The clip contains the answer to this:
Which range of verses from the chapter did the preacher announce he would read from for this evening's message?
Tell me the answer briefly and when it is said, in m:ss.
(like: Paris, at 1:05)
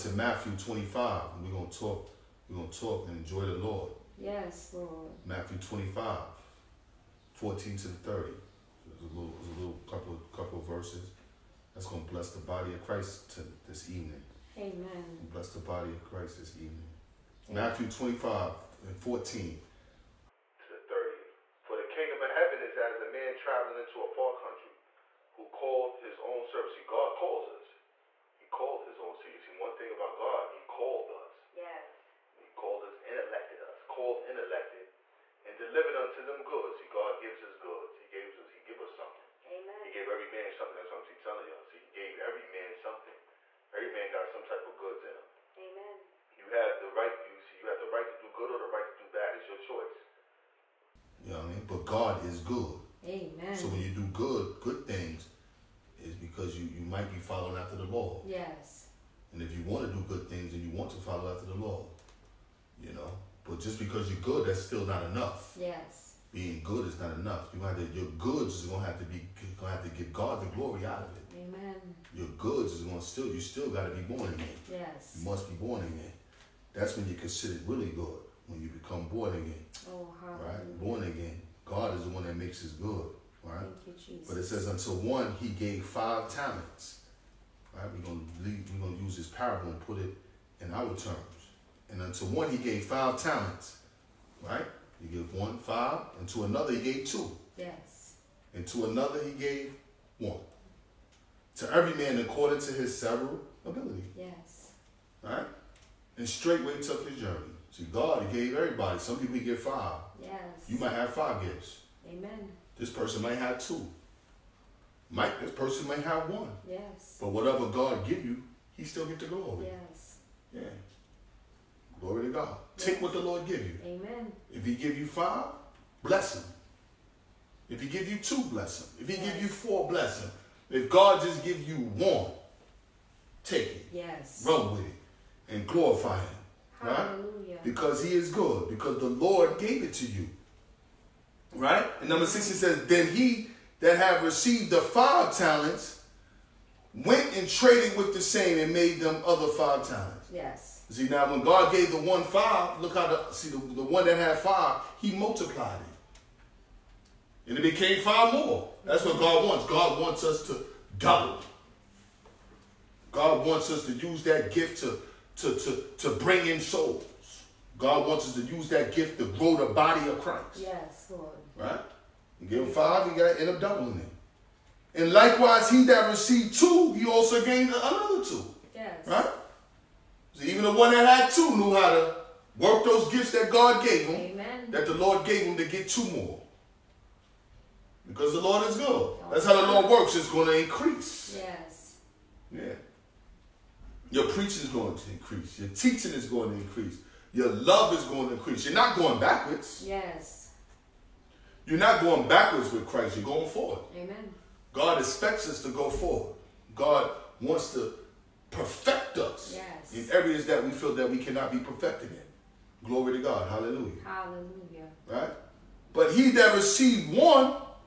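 14 to 30, at 0:07.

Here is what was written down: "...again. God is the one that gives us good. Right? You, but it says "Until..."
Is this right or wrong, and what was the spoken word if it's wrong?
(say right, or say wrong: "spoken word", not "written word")
wrong: "makes", not "gives".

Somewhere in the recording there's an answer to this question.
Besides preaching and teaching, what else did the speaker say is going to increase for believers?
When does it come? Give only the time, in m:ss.
3:17.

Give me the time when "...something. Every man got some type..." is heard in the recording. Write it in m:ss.
0:42.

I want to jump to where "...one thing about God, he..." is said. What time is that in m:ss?
0:29.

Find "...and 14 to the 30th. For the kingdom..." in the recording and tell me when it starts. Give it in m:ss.
0:18.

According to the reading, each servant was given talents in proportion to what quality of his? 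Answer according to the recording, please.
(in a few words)
his several ability.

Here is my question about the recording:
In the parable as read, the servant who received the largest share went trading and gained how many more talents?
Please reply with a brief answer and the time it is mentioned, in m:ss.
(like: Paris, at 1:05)
5, at 2:28.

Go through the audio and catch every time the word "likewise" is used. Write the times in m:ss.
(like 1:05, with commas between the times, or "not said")
2:55.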